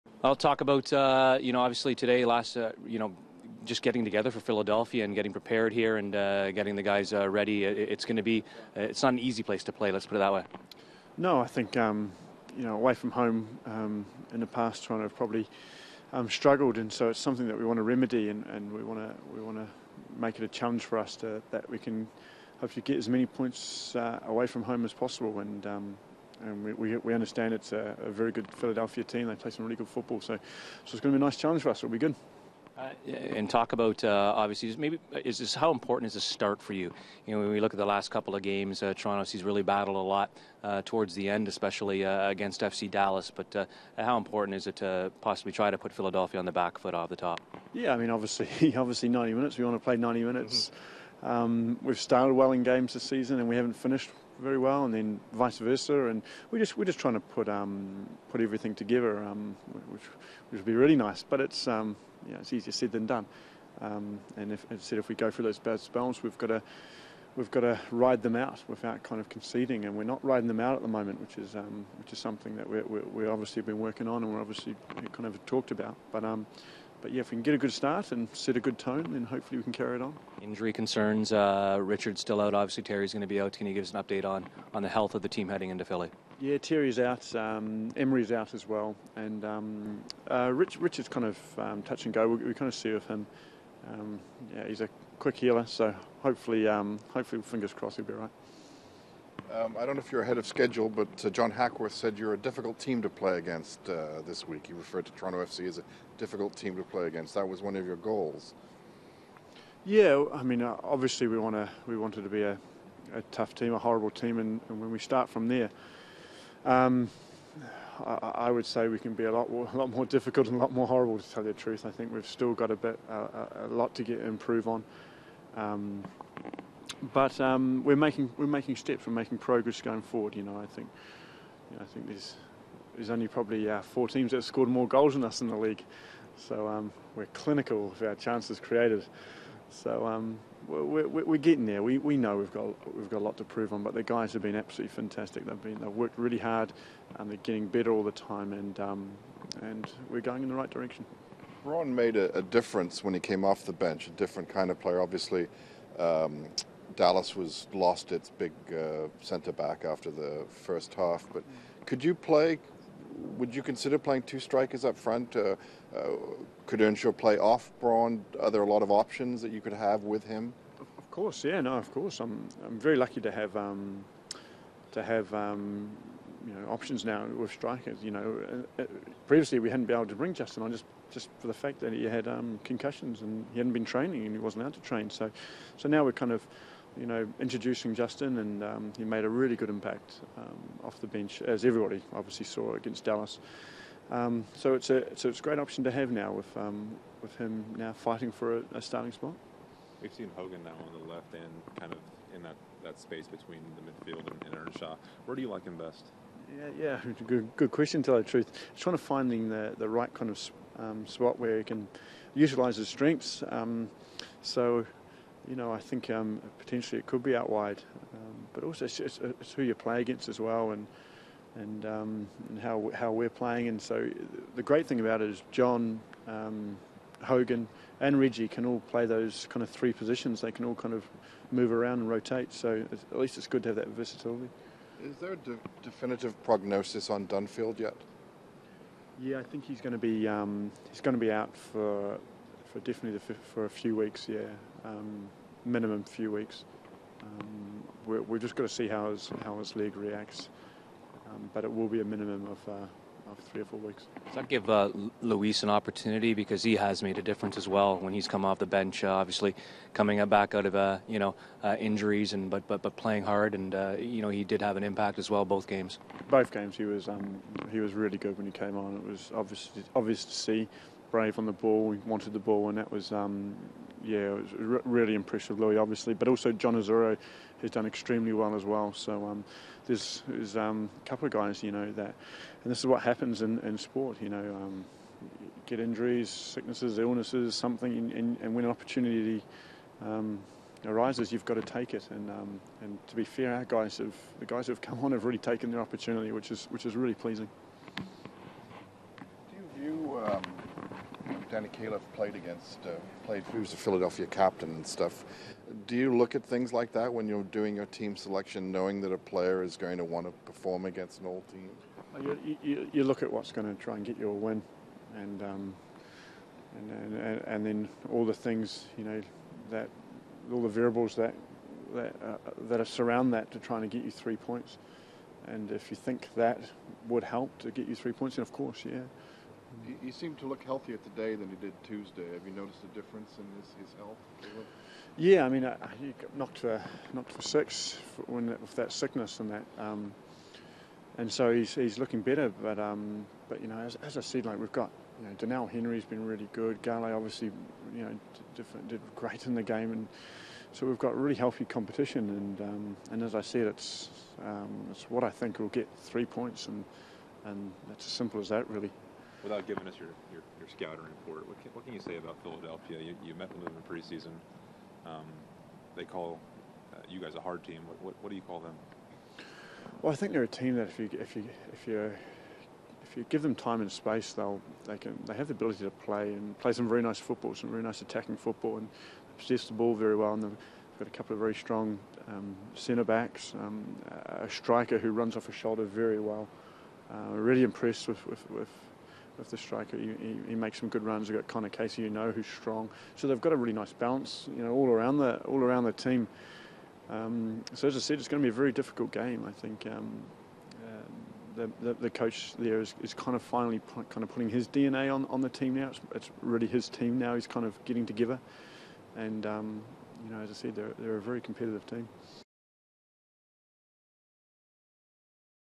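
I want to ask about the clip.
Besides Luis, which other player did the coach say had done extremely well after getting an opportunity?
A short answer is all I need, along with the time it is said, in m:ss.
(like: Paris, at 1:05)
John Osorio, at 4:36.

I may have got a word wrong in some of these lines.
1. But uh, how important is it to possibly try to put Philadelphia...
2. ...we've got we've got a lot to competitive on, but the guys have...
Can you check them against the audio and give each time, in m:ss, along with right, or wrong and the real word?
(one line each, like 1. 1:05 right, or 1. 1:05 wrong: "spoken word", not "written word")
1. 0:43 right
2. 2:22 wrong: "prove", not "competitive".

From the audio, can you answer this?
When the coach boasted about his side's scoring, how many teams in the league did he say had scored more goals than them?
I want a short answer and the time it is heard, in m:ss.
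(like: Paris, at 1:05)
4, at 2:13.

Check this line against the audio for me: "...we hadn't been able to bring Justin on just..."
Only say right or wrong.
right.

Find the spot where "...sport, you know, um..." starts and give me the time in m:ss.
4:43.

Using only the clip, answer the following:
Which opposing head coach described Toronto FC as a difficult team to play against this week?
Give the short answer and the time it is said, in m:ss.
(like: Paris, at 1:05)
John Hackworth, at 1:41.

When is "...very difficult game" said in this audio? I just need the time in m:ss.
6:38.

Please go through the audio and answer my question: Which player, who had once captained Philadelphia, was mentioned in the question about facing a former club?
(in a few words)
Danny Califf.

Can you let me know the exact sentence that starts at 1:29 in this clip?
And um, uh, Rich, Richard's kind of um, touch and go.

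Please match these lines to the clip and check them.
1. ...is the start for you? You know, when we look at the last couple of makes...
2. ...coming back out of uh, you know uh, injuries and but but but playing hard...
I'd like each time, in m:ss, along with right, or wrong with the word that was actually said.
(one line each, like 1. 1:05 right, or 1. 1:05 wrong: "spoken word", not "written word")
1. 0:36 wrong: "games", not "makes"
2. 4:19 right.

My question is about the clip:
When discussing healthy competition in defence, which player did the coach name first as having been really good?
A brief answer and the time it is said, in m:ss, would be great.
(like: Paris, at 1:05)
Doneil Henry, at 5:45.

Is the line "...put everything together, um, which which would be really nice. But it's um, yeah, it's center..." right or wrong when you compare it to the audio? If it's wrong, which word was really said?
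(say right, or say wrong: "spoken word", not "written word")
wrong: "easier", not "center".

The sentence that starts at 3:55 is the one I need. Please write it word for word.
Is there a de- definitive prognosis on Dunfield yet?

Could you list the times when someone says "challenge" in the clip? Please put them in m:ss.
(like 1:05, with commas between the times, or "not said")
0:20, 0:31.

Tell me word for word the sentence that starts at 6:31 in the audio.
You've got Conor Casey, you know, who's strong.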